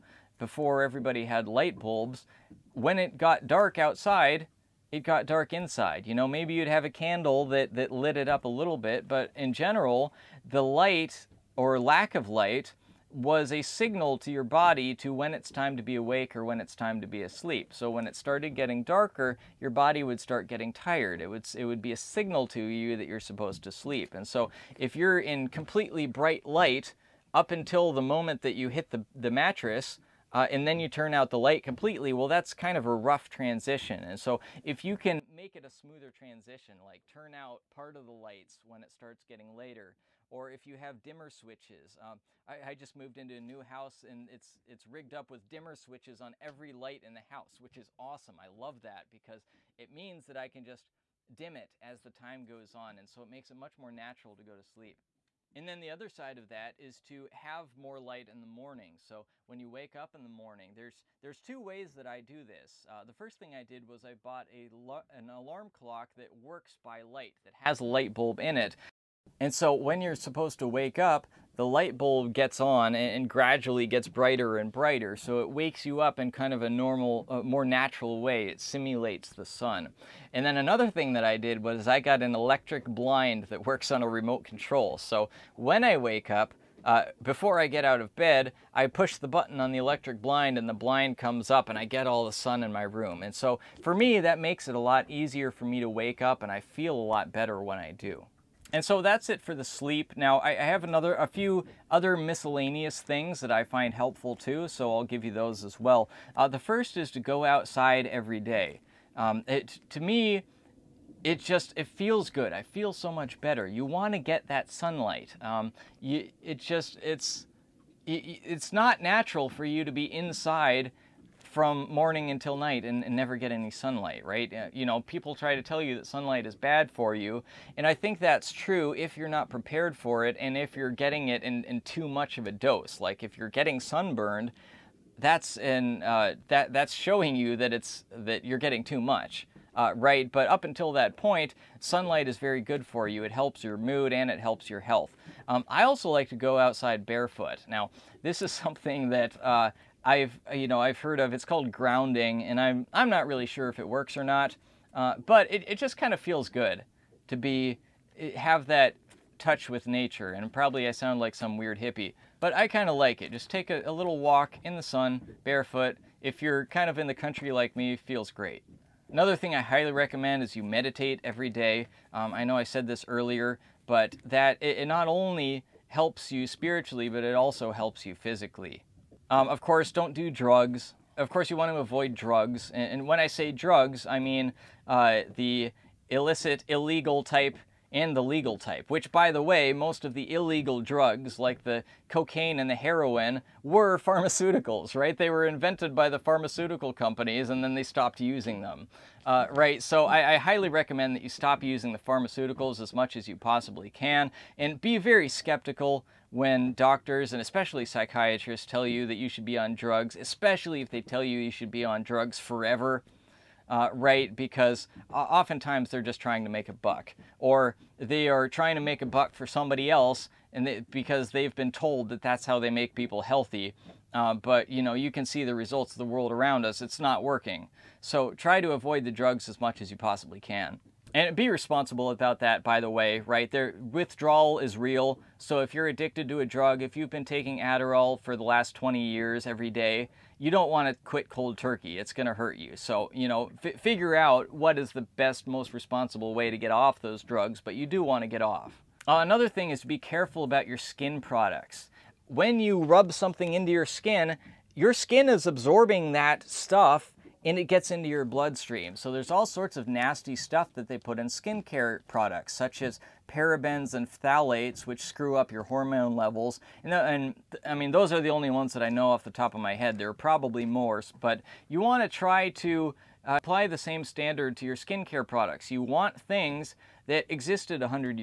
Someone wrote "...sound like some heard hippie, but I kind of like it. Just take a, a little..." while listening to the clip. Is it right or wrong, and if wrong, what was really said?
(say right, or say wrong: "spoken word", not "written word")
wrong: "weird", not "heard".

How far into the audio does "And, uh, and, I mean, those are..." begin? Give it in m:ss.
4:26.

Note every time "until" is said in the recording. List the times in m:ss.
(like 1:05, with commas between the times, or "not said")
0:27, 2:02, 2:20.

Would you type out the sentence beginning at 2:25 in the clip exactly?
Um, I also like to go outside barefoot.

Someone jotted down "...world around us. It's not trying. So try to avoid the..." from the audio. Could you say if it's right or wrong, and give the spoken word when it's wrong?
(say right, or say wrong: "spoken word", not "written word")
wrong: "working", not "trying".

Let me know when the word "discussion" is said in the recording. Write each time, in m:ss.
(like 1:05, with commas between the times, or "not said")
not said.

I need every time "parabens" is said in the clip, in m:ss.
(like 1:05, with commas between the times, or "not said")
4:23.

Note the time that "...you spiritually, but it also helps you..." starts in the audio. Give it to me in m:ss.
2:56.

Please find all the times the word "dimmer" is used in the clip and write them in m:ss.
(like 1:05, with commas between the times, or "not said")
0:41, 0:45.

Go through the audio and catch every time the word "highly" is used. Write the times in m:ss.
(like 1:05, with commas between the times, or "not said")
2:49, 3:20.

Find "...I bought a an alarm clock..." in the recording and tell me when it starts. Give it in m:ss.
1:04.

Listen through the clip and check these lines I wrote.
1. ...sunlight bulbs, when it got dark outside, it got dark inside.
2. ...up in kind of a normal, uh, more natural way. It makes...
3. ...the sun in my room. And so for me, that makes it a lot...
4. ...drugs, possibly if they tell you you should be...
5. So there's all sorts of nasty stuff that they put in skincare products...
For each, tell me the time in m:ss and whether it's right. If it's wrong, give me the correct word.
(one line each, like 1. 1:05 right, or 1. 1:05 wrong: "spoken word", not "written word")
1. 0:01 wrong: "light", not "sunlight"
2. 1:15 wrong: "simulates", not "makes"
3. 1:32 right
4. 3:29 wrong: "especially", not "possibly"
5. 4:18 right.